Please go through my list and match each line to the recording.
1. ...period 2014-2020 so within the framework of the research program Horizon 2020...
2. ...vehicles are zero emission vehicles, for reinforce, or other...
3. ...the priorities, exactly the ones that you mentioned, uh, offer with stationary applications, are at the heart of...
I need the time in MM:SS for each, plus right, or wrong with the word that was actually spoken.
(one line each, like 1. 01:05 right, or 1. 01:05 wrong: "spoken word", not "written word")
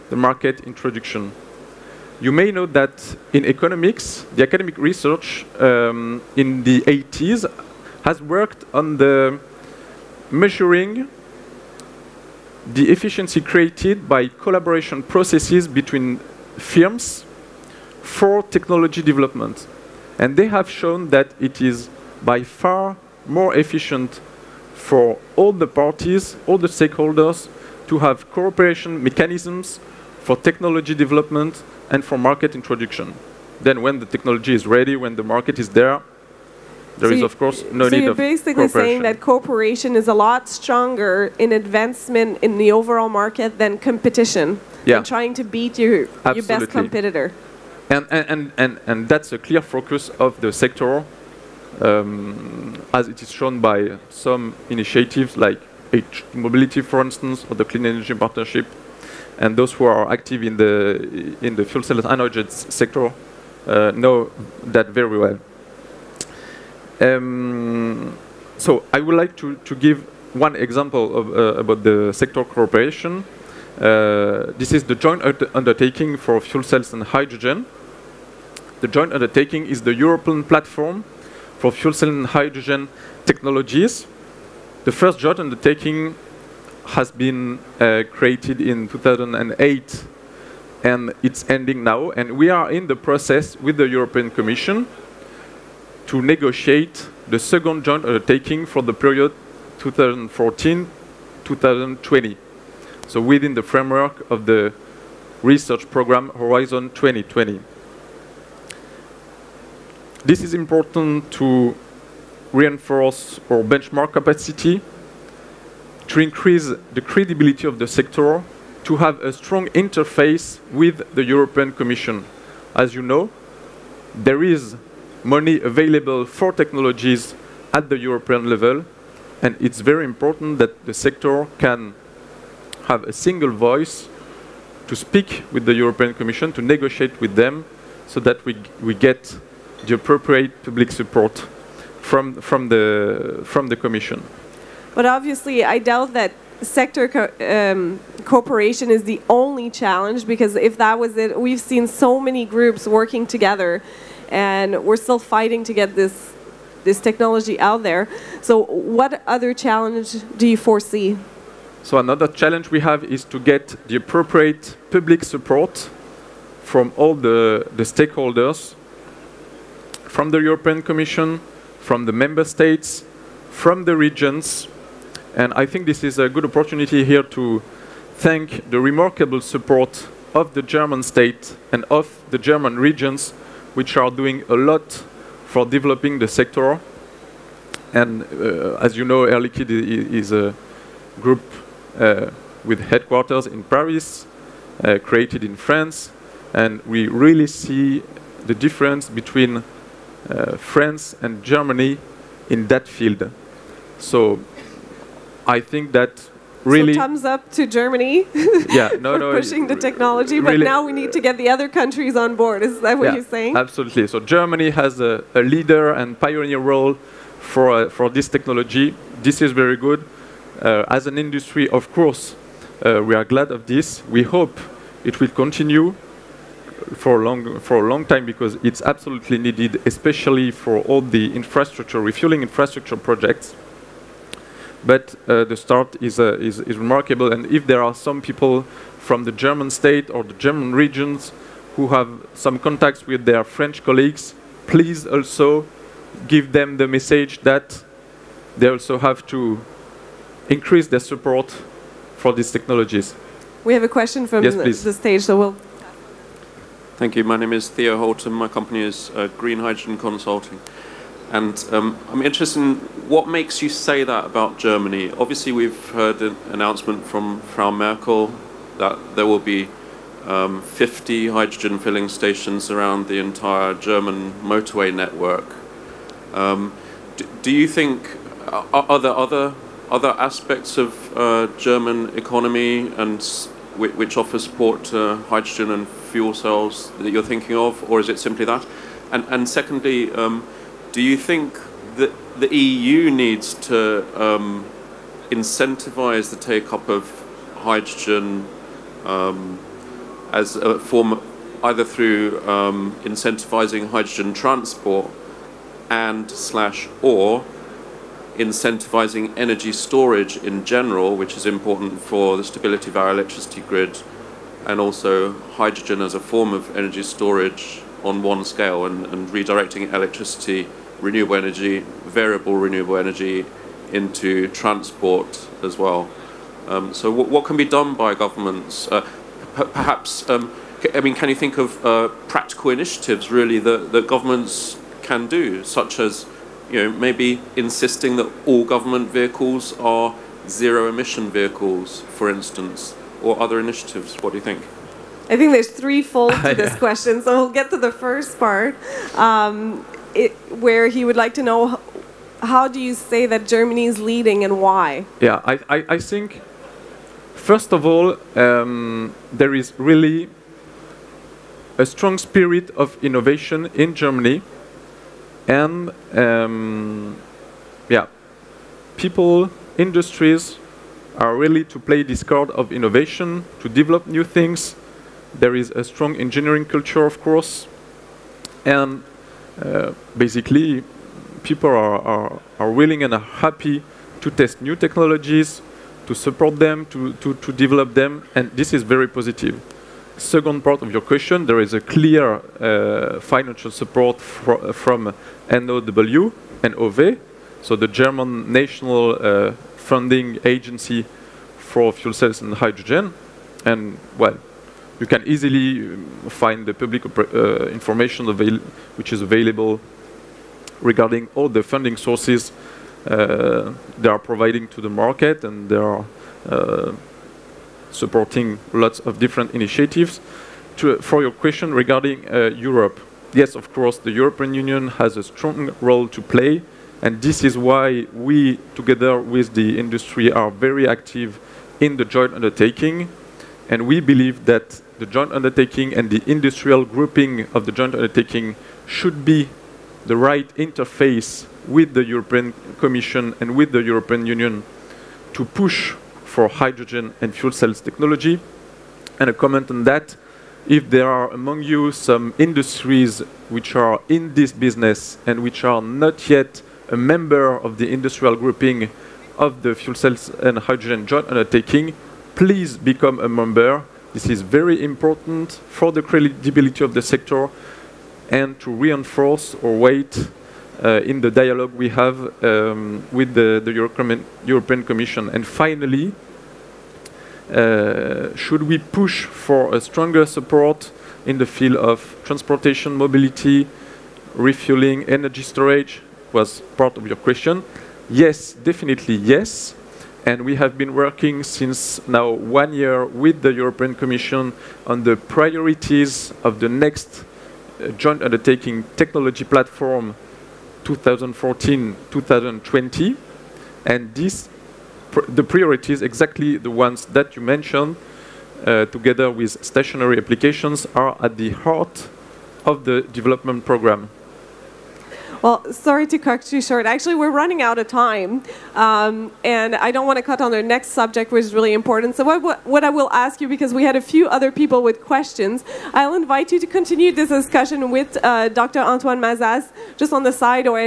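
1. 01:38 right
2. 05:39 wrong: "instance", not "reinforce"
3. 08:25 wrong: "together", not "offer".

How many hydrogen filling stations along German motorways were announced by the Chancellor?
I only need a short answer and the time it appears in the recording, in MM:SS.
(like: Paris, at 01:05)
50, at 04:30.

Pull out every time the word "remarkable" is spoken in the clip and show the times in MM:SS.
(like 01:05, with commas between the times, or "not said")
02:58, 03:56.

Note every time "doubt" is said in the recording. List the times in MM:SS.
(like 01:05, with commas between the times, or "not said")
02:25.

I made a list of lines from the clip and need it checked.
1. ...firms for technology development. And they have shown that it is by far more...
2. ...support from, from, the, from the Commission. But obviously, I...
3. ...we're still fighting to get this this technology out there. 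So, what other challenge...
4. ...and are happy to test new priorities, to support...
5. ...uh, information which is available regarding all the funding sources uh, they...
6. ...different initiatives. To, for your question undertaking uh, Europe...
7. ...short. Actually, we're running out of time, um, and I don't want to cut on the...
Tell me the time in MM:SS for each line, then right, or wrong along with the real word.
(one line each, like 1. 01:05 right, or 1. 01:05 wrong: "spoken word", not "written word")
1. 00:16 right
2. 02:20 right
3. 02:34 right
4. 06:23 wrong: "technologies", not "priorities"
5. 06:47 right
6. 06:59 wrong: "regarding", not "undertaking"
7. 08:36 right.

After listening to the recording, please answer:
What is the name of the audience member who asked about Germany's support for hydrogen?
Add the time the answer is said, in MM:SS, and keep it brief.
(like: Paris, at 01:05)
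Theo Holt, at 04:17.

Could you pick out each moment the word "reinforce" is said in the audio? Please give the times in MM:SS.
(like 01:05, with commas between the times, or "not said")
01:52, 07:48.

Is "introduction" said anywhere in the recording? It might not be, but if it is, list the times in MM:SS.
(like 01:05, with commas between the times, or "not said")
00:00, 00:32.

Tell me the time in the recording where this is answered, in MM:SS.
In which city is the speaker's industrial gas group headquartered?
03:13.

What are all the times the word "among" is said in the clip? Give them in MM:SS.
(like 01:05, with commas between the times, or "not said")
07:31.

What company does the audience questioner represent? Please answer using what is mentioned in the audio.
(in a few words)
Green Hydrogen Consulting.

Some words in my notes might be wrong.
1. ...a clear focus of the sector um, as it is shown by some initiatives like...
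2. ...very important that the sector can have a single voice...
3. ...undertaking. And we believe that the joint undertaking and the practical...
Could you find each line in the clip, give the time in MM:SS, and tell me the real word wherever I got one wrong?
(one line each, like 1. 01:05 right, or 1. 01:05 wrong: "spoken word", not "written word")
1. 00:49 right
2. 02:09 right
3. 07:12 wrong: "industrial", not "practical".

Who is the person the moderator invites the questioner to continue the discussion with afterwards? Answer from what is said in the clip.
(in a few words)
Dr. Antoine Mazas.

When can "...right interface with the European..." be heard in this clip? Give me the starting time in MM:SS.
07:20.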